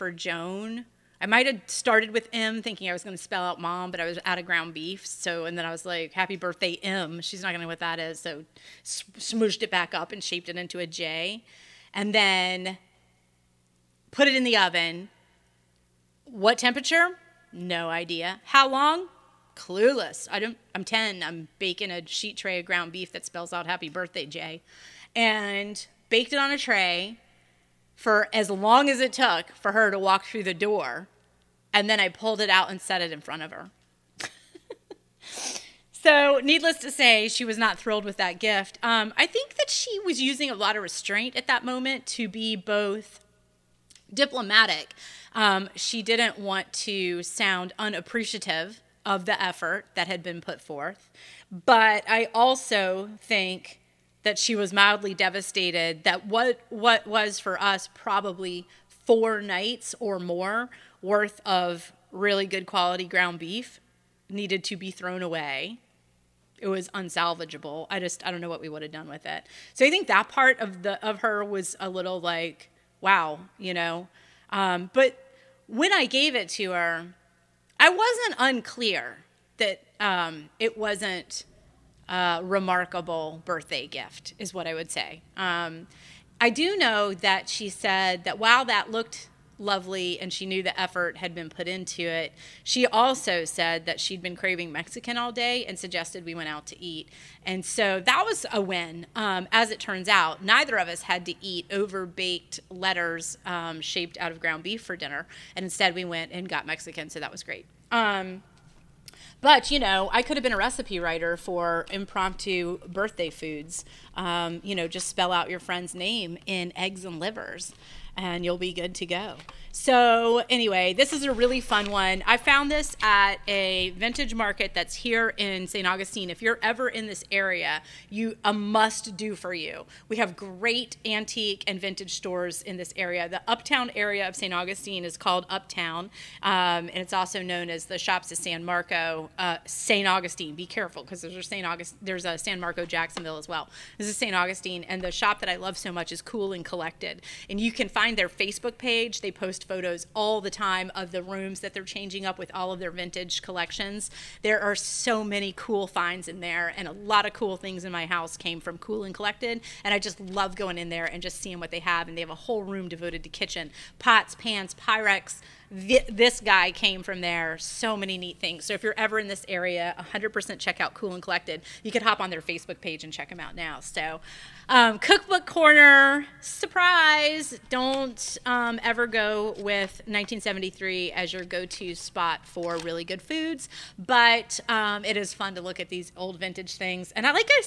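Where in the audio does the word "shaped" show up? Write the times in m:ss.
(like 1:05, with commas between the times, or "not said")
0:10, 1:43.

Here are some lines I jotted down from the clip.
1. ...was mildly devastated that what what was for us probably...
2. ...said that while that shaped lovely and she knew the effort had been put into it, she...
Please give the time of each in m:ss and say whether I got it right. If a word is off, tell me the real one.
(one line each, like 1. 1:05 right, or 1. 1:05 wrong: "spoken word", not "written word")
1. 0:54 right
2. 1:27 wrong: "looked", not "shaped".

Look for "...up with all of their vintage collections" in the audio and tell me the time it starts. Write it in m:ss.
2:32.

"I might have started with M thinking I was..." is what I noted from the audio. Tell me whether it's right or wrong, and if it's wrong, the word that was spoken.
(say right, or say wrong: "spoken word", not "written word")
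right.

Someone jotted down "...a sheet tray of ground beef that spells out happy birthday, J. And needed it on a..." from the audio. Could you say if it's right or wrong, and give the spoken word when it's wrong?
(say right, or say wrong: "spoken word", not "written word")
wrong: "baked", not "needed".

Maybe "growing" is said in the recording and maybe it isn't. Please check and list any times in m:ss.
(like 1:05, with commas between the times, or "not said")
not said.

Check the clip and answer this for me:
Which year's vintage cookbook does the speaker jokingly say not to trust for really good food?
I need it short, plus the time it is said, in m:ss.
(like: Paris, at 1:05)
1973, at 3:00.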